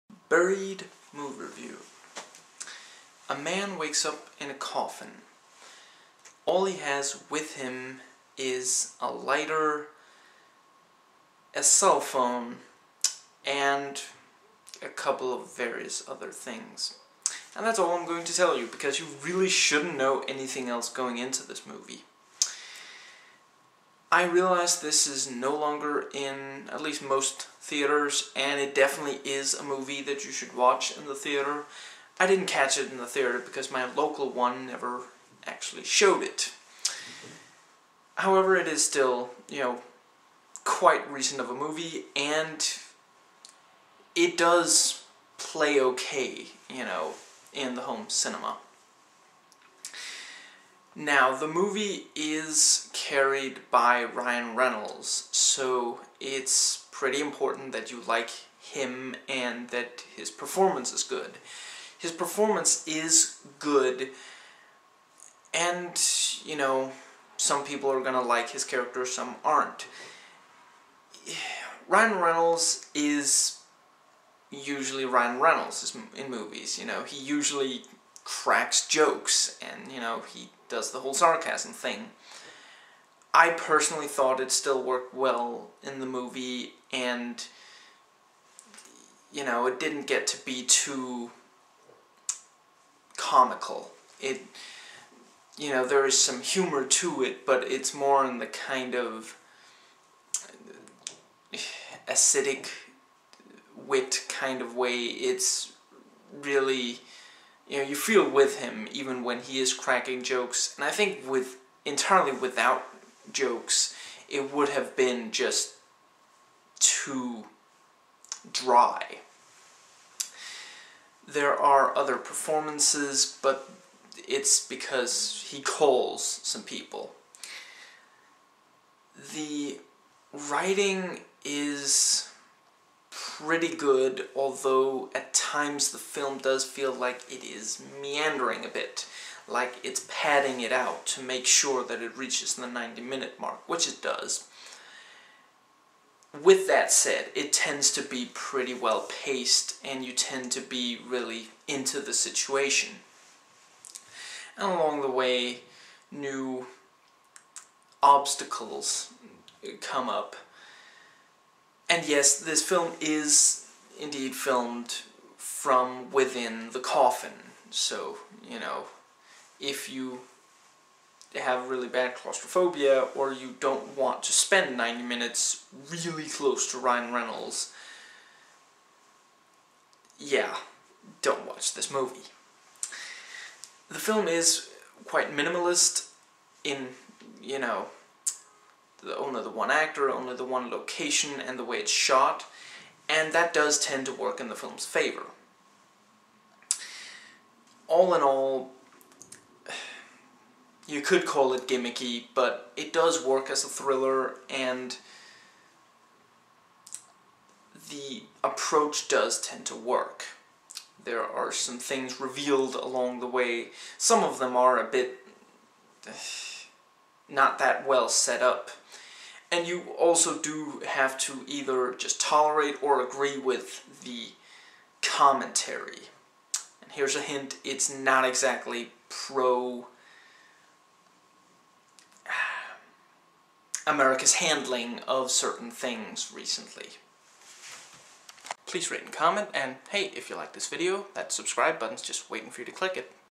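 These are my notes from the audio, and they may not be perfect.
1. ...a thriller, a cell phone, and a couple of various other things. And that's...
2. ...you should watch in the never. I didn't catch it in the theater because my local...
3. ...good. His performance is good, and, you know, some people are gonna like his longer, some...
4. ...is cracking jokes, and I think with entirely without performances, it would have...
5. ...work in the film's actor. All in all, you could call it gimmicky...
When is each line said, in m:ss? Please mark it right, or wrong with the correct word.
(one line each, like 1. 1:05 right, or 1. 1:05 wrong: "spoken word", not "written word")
1. 0:09 wrong: "lighter", not "thriller"
2. 0:30 wrong: "theater", not "never"
3. 1:01 wrong: "character", not "longer"
4. 1:49 wrong: "jokes", not "performances"
5. 3:14 wrong: "favor", not "actor".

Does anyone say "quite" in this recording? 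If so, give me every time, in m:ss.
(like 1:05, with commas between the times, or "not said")
0:40, 3:05.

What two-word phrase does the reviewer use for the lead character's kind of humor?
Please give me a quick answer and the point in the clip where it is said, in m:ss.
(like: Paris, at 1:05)
acidic wit, at 1:42.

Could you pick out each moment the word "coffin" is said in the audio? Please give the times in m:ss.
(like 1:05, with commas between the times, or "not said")
0:04, 2:46.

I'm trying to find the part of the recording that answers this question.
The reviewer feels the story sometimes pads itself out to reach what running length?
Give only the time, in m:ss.
2:22.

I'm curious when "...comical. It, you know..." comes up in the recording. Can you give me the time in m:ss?
1:33.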